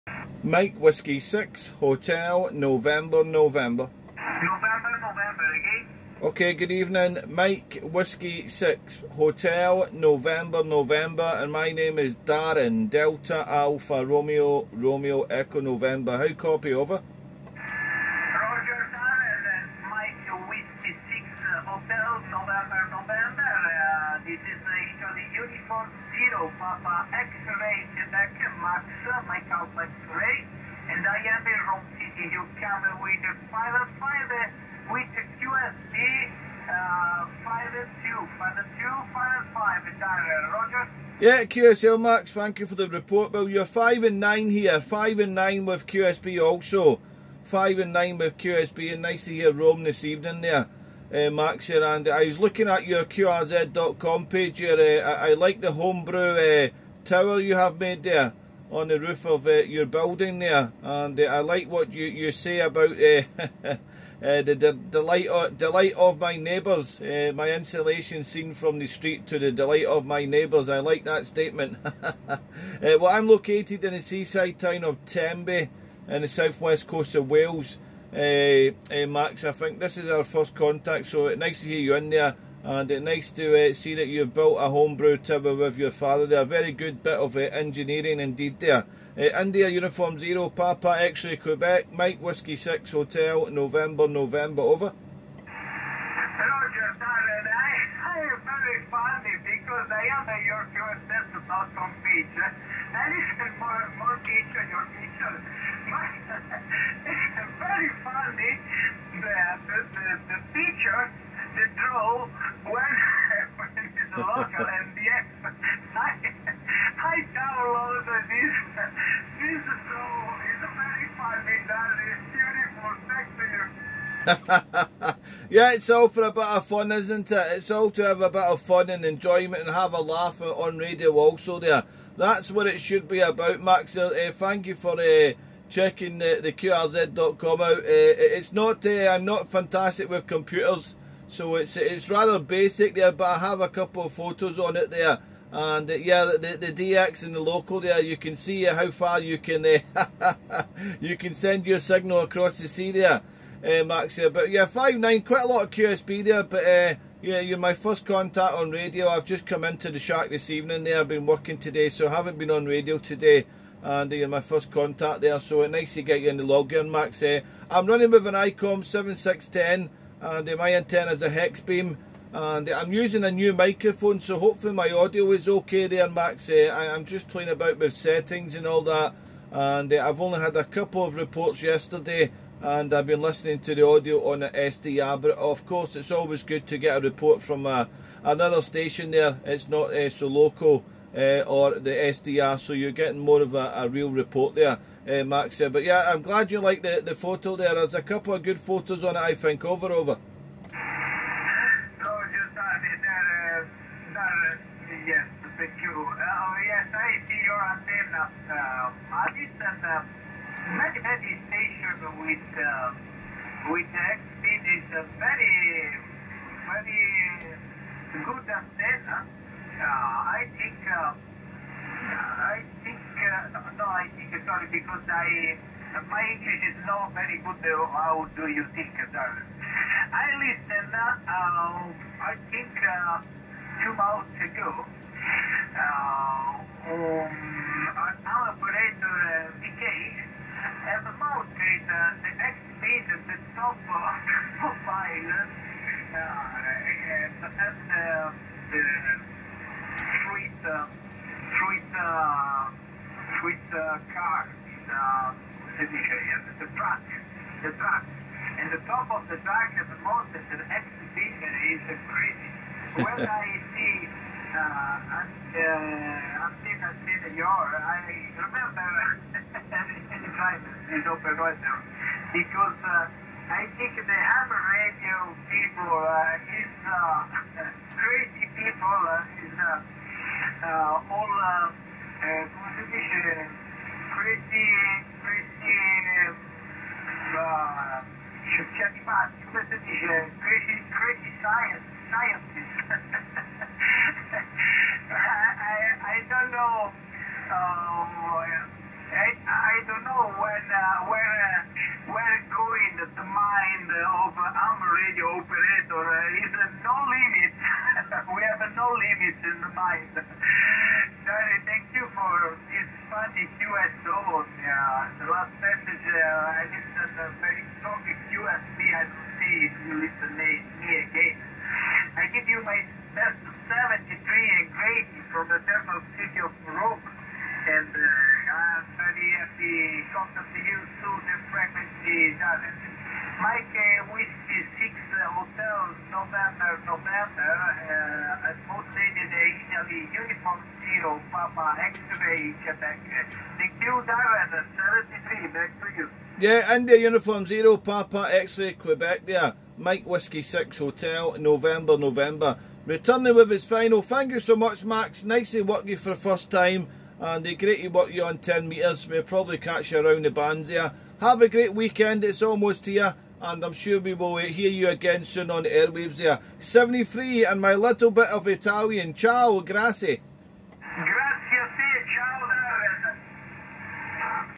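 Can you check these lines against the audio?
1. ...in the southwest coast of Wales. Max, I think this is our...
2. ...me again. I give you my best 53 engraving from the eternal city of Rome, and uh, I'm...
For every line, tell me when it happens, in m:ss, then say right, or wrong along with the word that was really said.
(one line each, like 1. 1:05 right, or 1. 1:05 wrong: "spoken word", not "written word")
1. 1:16 right
2. 5:20 wrong: "73", not "53".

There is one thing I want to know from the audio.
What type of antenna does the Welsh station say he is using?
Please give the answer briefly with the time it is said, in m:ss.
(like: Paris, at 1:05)
Hex beam, at 2:51.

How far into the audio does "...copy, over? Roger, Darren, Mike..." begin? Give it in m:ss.
0:16.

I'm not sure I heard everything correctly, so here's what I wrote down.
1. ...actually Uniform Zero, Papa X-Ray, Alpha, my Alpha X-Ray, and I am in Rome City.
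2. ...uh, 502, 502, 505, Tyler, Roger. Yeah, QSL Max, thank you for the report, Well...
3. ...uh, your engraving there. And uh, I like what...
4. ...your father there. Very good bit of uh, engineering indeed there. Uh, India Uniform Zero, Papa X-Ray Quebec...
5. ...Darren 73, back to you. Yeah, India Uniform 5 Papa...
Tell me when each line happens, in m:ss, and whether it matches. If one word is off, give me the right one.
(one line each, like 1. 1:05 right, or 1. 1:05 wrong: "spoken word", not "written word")
1. 0:24 wrong: "Maxa", not "Alpha"
2. 0:36 right
3. 0:59 wrong: "building", not "engraving"
4. 1:25 right
5. 5:44 wrong: "0", not "5".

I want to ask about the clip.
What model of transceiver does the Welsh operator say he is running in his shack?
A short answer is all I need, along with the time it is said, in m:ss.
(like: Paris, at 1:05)
ICOM 7610, at 2:48.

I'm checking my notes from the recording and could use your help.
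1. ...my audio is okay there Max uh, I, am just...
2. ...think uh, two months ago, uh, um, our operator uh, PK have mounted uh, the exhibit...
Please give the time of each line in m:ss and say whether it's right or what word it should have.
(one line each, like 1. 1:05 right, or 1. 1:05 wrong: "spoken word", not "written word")
1. 2:54 right
2. 3:52 right.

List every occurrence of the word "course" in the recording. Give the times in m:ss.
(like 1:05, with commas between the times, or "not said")
3:05.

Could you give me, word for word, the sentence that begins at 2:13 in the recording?
Uh, uh thank you for uh, checking the, the QRZ.com out.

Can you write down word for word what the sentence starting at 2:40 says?
There, I've been working today, so I haven't been on radio today and uh, you're my first contact there.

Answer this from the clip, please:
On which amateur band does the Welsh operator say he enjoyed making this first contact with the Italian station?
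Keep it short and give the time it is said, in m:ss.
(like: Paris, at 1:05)
10 metres, at 5:58.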